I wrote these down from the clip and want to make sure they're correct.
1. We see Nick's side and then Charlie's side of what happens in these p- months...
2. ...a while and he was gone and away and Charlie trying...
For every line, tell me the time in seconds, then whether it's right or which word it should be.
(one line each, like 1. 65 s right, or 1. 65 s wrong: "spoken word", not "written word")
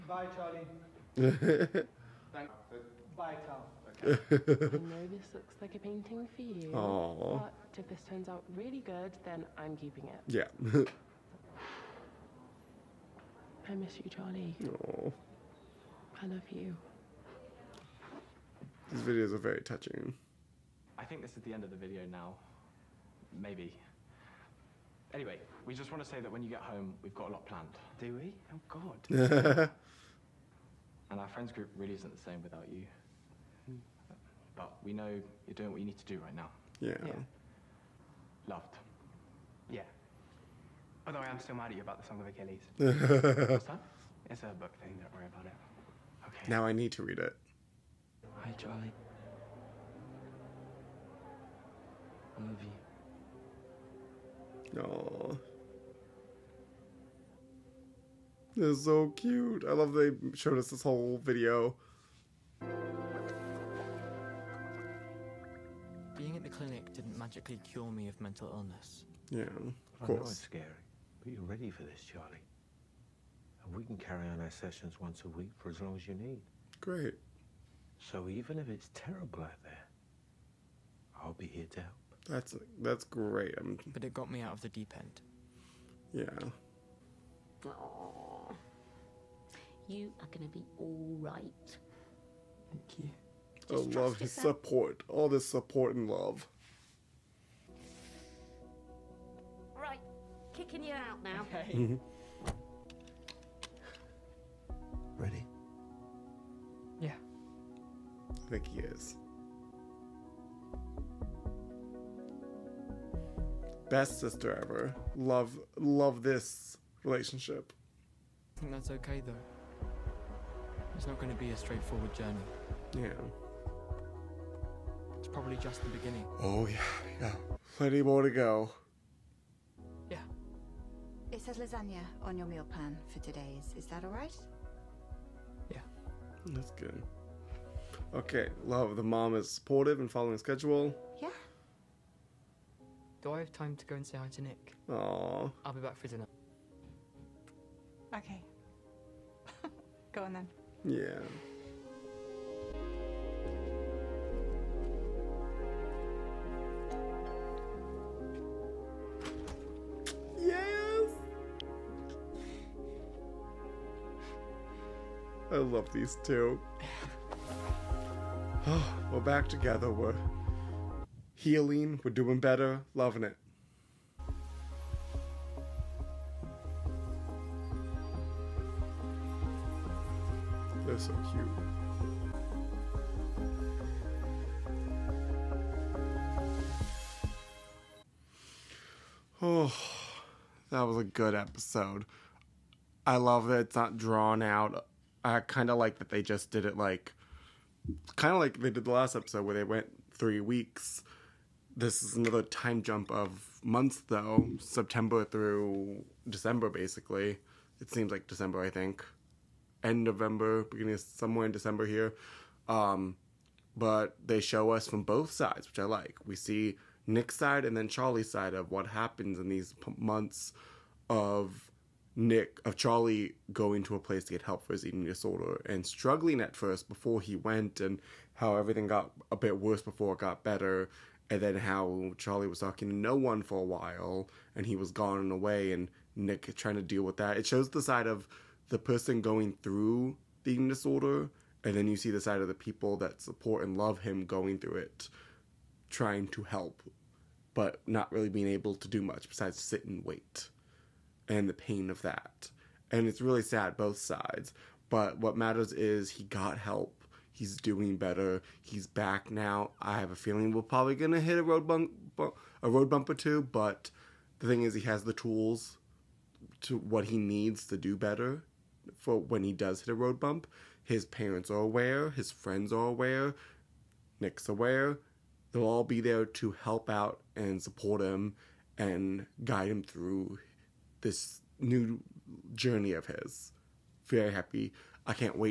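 1. 216 s right
2. 233 s wrong: "Nick", not "Charlie".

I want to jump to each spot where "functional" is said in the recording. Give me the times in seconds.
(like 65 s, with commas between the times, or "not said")
not said.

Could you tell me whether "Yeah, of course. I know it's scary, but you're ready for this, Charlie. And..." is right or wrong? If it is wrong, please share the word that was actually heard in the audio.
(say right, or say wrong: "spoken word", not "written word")
right.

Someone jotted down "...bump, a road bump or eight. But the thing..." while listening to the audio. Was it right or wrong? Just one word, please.
wrong.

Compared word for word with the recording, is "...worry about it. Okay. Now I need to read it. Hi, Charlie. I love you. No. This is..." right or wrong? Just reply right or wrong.
right.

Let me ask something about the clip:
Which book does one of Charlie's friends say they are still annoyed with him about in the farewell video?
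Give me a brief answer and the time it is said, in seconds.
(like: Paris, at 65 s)
The Song of Achilles, at 42 s.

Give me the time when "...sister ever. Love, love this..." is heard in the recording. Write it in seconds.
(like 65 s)
114 s.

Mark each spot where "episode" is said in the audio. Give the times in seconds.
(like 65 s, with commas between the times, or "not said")
191 s, 199 s.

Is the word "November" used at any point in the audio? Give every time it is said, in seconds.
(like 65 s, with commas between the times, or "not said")
210 s.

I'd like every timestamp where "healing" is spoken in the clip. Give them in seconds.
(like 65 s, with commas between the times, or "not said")
171 s.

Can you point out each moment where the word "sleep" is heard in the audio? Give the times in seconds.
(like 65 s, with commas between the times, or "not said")
not said.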